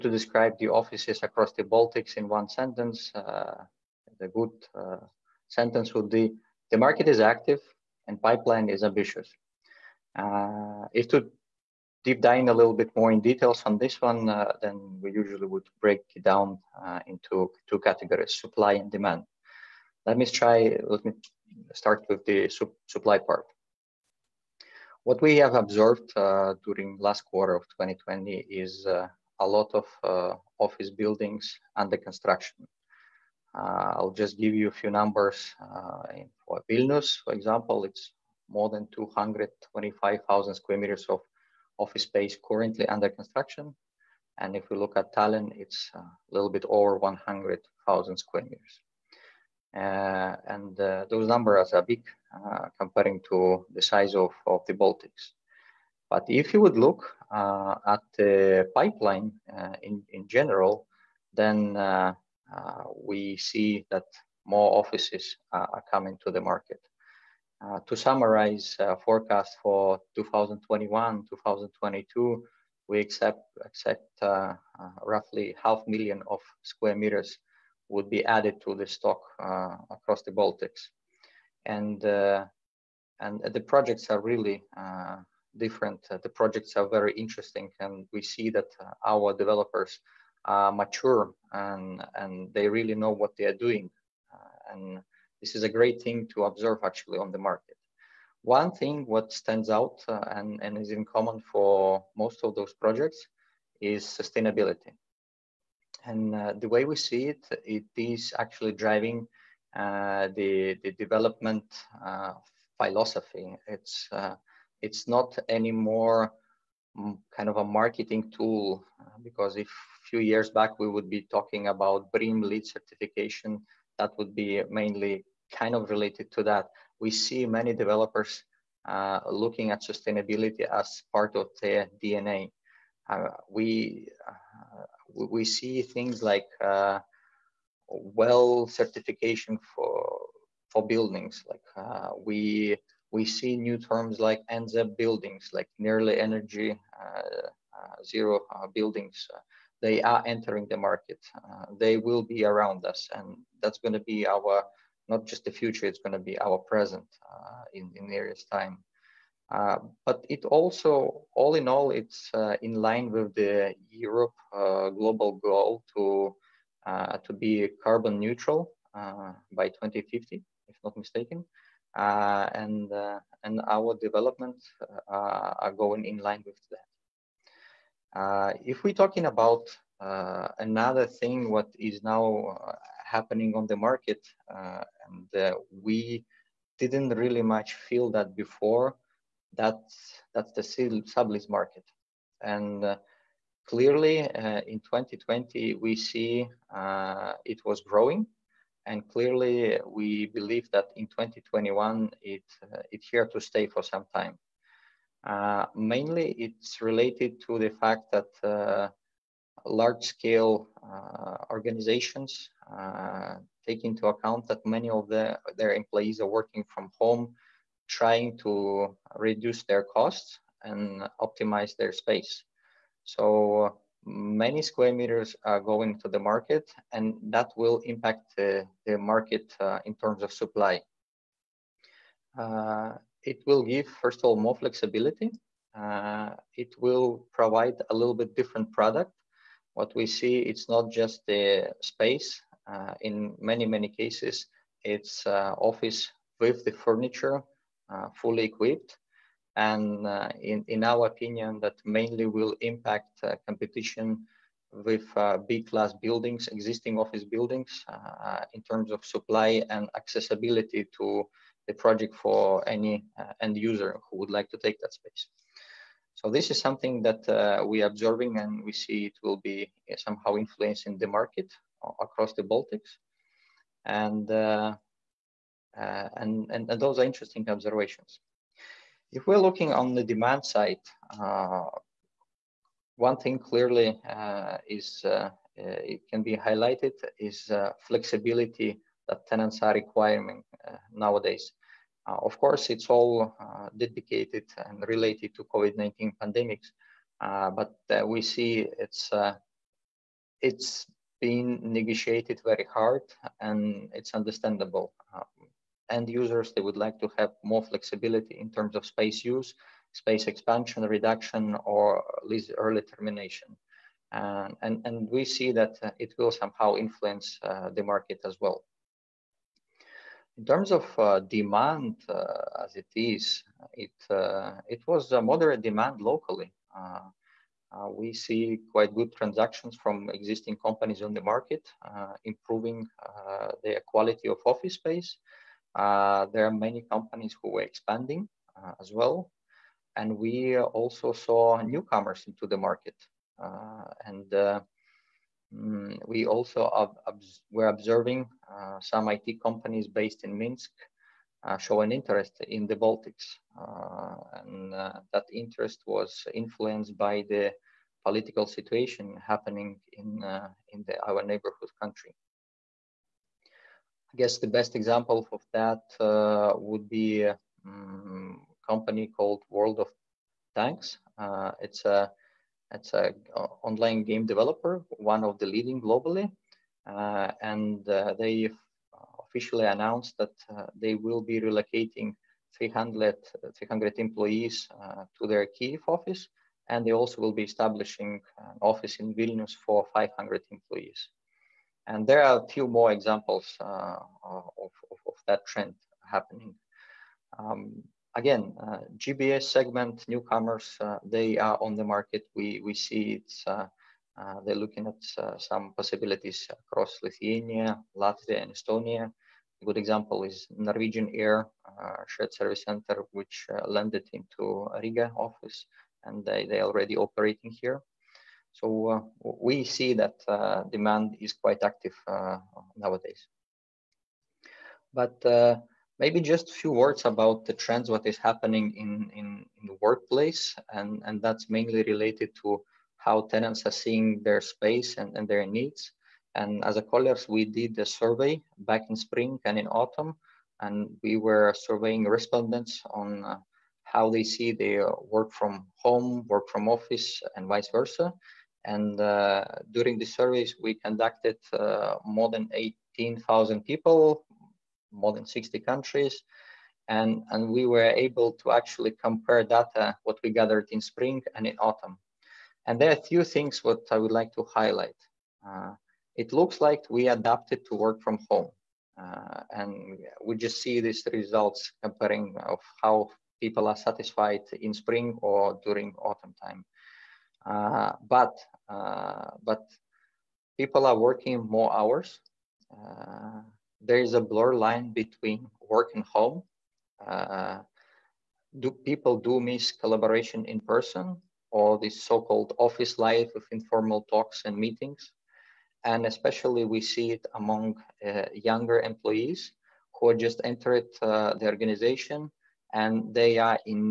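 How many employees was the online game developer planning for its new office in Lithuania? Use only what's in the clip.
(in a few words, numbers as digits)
500.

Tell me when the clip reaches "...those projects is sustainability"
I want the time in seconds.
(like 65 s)
102 s.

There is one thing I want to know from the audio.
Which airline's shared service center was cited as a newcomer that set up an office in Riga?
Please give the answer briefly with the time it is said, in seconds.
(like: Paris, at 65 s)
Norwegian Air, at 410 s.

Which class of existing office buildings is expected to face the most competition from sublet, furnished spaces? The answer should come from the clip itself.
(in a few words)
B-class.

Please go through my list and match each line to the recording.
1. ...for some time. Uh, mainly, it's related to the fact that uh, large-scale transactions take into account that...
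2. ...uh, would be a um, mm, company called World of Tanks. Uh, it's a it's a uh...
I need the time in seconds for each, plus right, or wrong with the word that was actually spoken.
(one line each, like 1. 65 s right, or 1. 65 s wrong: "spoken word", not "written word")
1. 203 s wrong: "organizations", not "transactions"
2. 365 s right.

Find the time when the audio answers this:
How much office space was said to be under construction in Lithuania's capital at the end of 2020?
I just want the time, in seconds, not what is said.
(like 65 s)
38 s.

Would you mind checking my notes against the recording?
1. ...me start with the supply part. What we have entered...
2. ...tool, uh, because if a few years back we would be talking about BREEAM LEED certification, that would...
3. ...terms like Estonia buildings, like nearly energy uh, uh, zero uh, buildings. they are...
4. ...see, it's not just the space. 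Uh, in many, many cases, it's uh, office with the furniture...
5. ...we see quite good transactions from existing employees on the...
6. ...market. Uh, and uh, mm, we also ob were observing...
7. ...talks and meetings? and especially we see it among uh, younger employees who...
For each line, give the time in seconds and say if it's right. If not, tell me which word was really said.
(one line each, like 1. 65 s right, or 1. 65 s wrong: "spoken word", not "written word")
1. 21 s wrong: "observed", not "entered"
2. 118 s right
3. 143 s wrong: "NZEB", not "Estonia"
4. 240 s right
5. 327 s wrong: "companies", not "employees"
6. 342 s right
7. 494 s right.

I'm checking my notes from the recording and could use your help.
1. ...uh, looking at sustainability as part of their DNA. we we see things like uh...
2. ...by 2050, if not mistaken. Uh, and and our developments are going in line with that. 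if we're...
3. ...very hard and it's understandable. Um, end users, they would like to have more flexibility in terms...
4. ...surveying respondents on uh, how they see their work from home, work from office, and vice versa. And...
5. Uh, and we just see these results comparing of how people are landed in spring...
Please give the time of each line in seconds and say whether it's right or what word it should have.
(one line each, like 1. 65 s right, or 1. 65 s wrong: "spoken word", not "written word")
1. 128 s right
2. 169 s right
3. 302 s right
4. 441 s right
5. 468 s wrong: "satisfied", not "landed".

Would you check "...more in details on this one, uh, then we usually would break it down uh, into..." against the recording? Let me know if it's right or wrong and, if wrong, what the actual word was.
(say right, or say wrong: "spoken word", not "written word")
right.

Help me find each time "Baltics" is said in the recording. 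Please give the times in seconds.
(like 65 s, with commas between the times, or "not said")
1 s, 54 s, 80 s, 272 s, 352 s.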